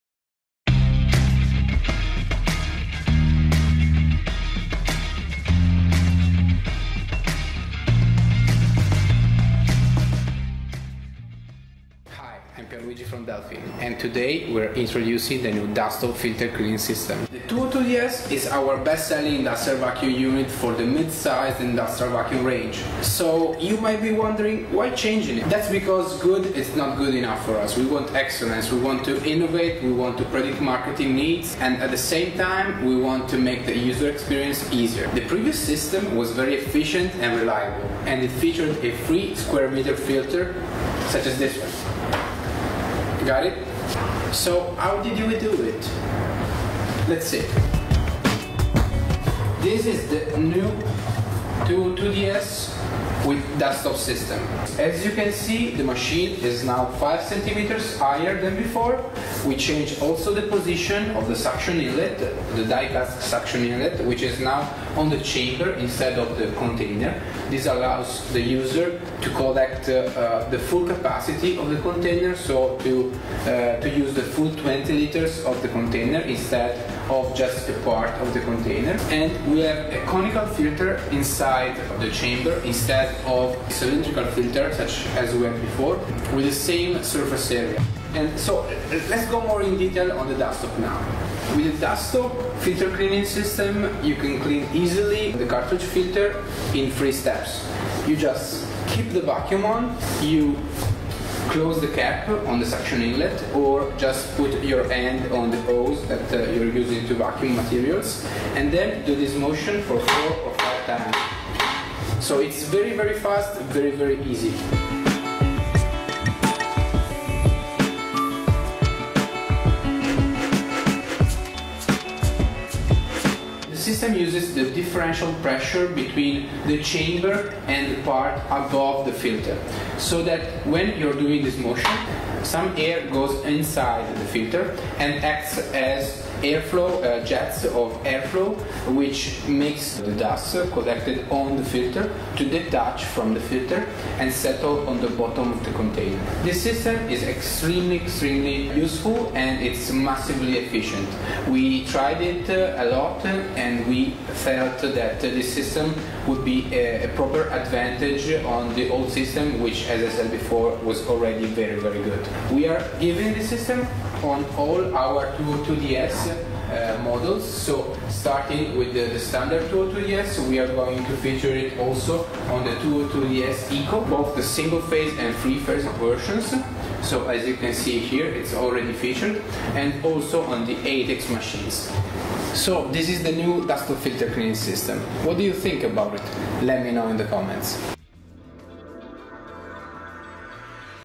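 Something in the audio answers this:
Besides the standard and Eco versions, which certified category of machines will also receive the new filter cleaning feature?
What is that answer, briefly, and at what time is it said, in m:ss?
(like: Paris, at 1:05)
ATEX machines, at 3:00.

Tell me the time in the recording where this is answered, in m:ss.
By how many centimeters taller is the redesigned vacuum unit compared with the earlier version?
0:56.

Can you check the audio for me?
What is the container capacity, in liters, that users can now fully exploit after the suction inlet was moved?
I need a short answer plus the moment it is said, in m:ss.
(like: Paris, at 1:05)
20 liters, at 1:14.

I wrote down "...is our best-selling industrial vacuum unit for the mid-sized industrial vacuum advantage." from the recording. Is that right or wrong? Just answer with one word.
wrong.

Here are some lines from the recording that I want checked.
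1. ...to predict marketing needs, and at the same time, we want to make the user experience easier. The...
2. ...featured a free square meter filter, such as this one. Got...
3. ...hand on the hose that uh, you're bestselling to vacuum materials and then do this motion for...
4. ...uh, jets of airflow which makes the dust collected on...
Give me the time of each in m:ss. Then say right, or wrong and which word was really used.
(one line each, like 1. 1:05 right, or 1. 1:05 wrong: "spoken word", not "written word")
1. 0:30 right
2. 0:38 right
3. 1:44 wrong: "using", not "bestselling"
4. 2:17 right.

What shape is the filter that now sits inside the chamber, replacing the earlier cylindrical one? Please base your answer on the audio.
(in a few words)
Conical.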